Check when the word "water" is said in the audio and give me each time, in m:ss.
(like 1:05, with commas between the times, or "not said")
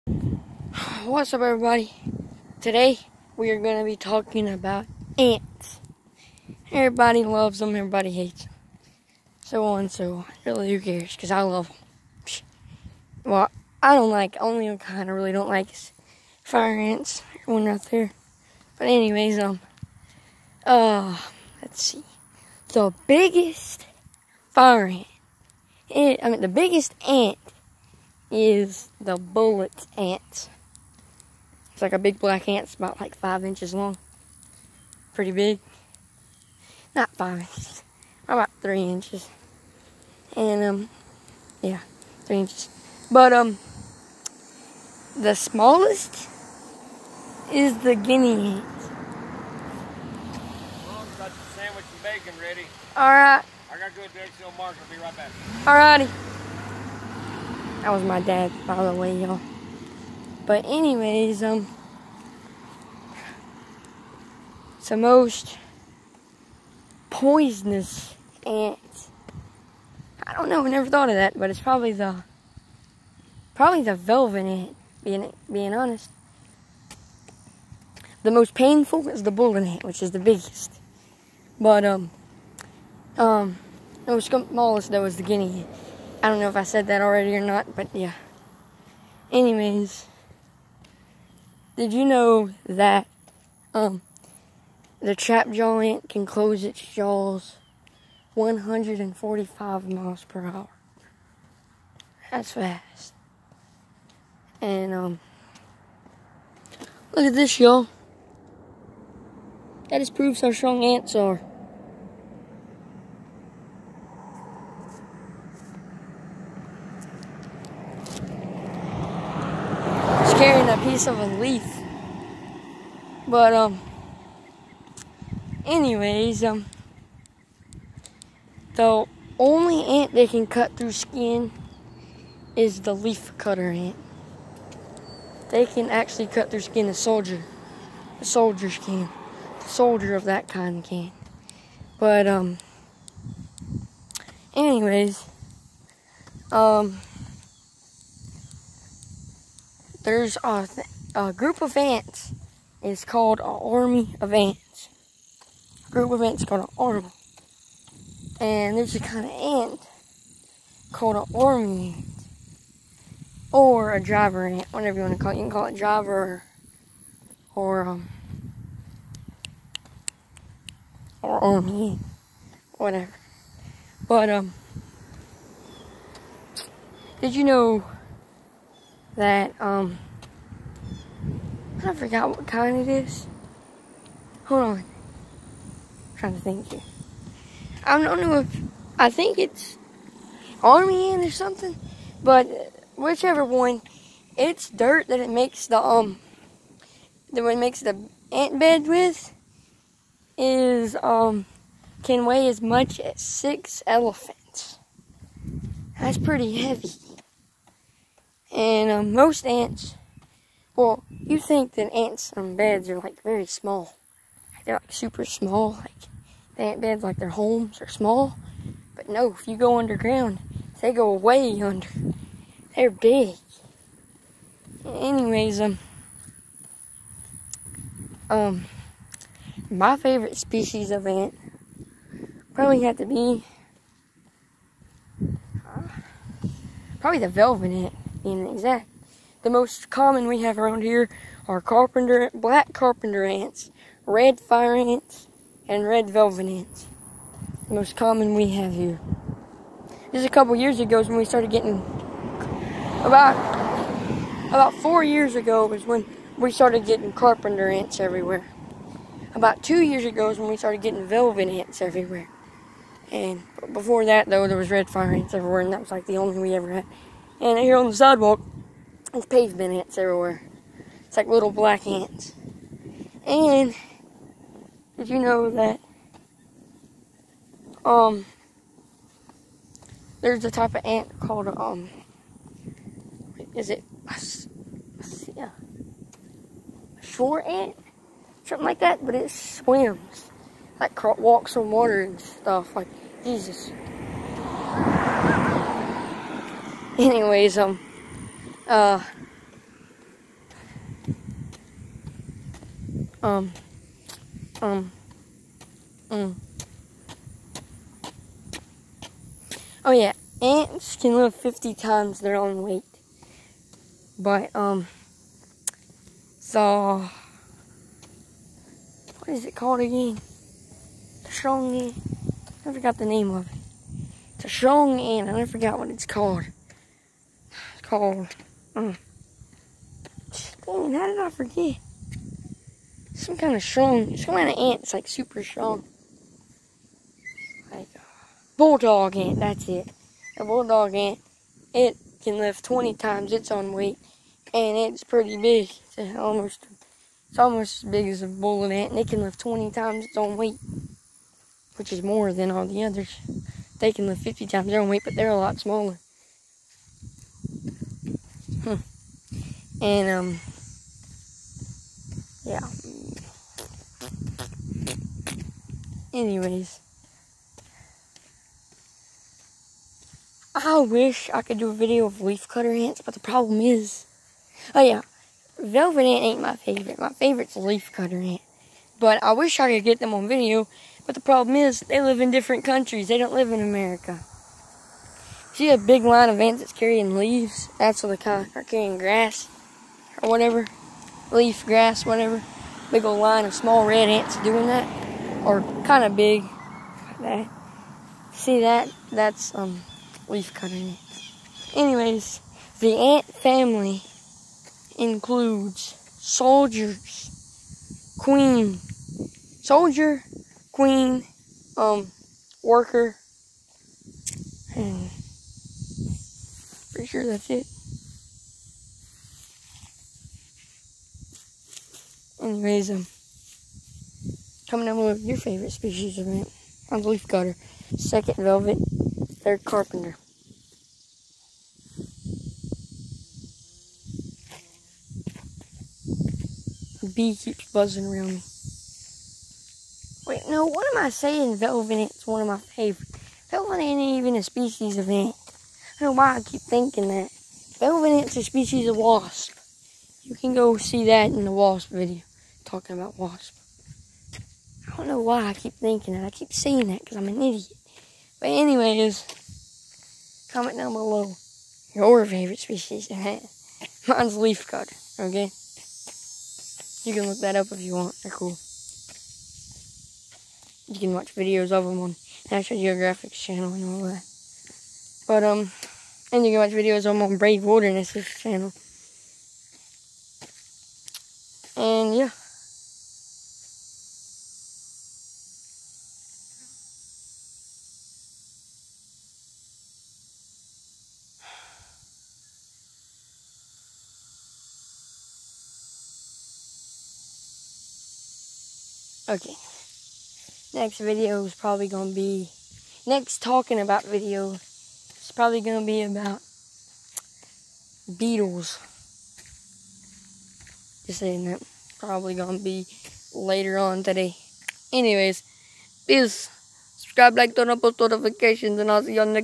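4:51.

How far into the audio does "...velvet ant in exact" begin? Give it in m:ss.
3:57.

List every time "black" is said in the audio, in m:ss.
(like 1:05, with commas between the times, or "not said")
0:32, 4:02, 4:31.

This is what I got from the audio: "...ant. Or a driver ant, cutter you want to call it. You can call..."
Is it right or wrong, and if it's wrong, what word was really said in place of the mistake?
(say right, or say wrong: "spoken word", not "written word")
wrong: "whatever", not "cutter".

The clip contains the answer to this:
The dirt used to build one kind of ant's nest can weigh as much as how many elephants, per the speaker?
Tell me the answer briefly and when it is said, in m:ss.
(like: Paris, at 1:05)
6, at 3:23.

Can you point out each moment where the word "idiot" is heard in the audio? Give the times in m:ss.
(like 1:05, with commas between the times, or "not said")
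7:37.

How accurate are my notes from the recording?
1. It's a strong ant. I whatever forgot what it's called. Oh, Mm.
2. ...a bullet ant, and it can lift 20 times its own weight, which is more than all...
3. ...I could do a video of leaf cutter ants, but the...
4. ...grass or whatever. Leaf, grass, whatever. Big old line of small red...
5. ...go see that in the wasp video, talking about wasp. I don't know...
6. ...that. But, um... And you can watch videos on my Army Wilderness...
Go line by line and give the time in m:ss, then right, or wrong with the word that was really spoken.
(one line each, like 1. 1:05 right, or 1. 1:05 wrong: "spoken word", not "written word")
1. 5:24 wrong: "never", not "whatever"
2. 5:48 right
3. 6:11 right
4. 6:28 right
5. 7:30 right
6. 7:54 wrong: "Brave", not "Army".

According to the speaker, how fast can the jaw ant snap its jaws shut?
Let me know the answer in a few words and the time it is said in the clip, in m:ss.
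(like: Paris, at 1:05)
145 miles per hour, at 1:38.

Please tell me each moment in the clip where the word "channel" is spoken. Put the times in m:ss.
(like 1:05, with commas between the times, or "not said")
7:53, 7:58.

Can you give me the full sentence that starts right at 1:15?
Being being honest, the most painful is the bullet ant, which is the biggest.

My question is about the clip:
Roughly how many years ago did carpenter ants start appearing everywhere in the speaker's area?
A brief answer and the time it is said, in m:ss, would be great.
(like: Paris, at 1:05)
4 years, at 4:14.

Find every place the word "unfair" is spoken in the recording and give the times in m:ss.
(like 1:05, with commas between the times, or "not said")
not said.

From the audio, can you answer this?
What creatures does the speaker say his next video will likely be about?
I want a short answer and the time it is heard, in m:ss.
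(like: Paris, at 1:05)
beetles, at 8:28.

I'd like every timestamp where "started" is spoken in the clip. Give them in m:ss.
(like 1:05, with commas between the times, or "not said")
4:11, 4:16, 4:20.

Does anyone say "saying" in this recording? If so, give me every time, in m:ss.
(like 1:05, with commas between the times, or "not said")
7:21, 7:36, 8:31.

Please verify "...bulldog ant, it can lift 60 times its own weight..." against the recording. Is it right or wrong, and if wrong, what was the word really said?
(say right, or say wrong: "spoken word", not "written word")
wrong: "20", not "60".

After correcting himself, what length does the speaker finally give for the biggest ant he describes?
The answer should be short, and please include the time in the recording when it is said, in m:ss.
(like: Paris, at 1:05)
3 inches, at 0:38.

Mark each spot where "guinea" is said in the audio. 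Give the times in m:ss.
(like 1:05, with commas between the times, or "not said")
0:47, 1:25.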